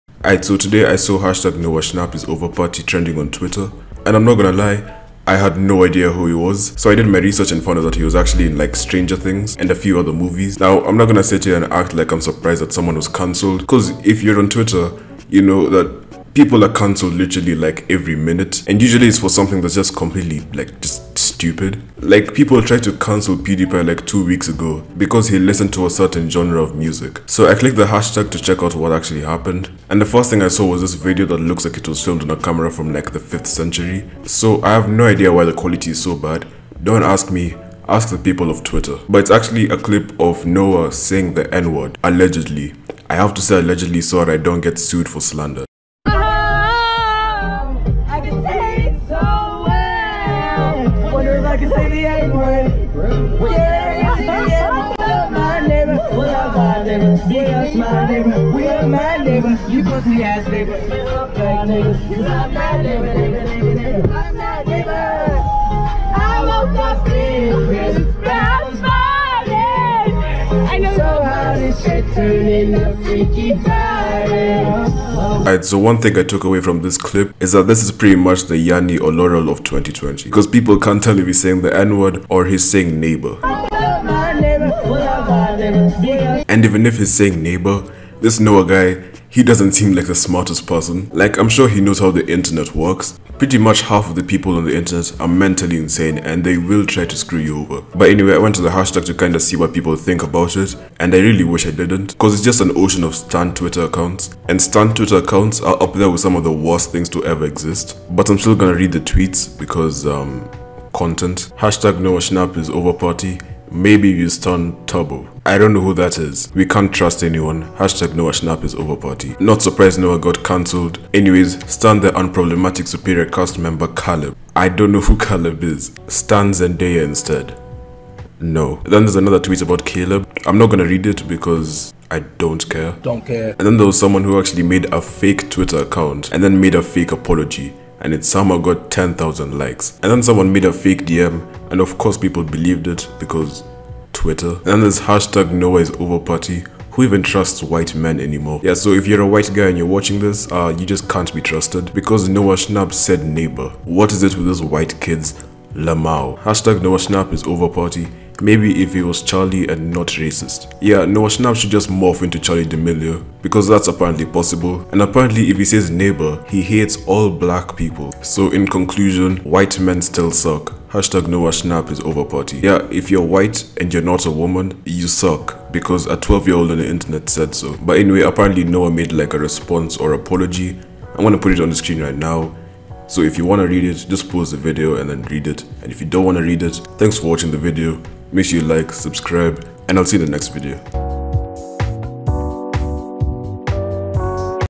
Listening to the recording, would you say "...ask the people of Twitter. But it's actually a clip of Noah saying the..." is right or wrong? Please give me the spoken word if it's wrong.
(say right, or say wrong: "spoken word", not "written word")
right.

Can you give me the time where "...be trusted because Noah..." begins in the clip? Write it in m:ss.
2:31.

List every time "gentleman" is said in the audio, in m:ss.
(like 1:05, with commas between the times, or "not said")
not said.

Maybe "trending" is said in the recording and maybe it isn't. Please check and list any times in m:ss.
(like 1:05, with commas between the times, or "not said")
0:02.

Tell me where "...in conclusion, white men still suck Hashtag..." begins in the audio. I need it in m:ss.
2:48.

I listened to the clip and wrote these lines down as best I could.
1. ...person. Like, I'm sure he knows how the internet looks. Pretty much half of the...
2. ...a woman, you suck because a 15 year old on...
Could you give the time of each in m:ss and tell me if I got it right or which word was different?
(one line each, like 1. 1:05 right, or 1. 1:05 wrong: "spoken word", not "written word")
1. 1:30 wrong: "works", not "looks"
2. 2:54 wrong: "12", not "15".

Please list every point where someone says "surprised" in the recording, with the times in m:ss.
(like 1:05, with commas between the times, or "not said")
0:12, 1:59.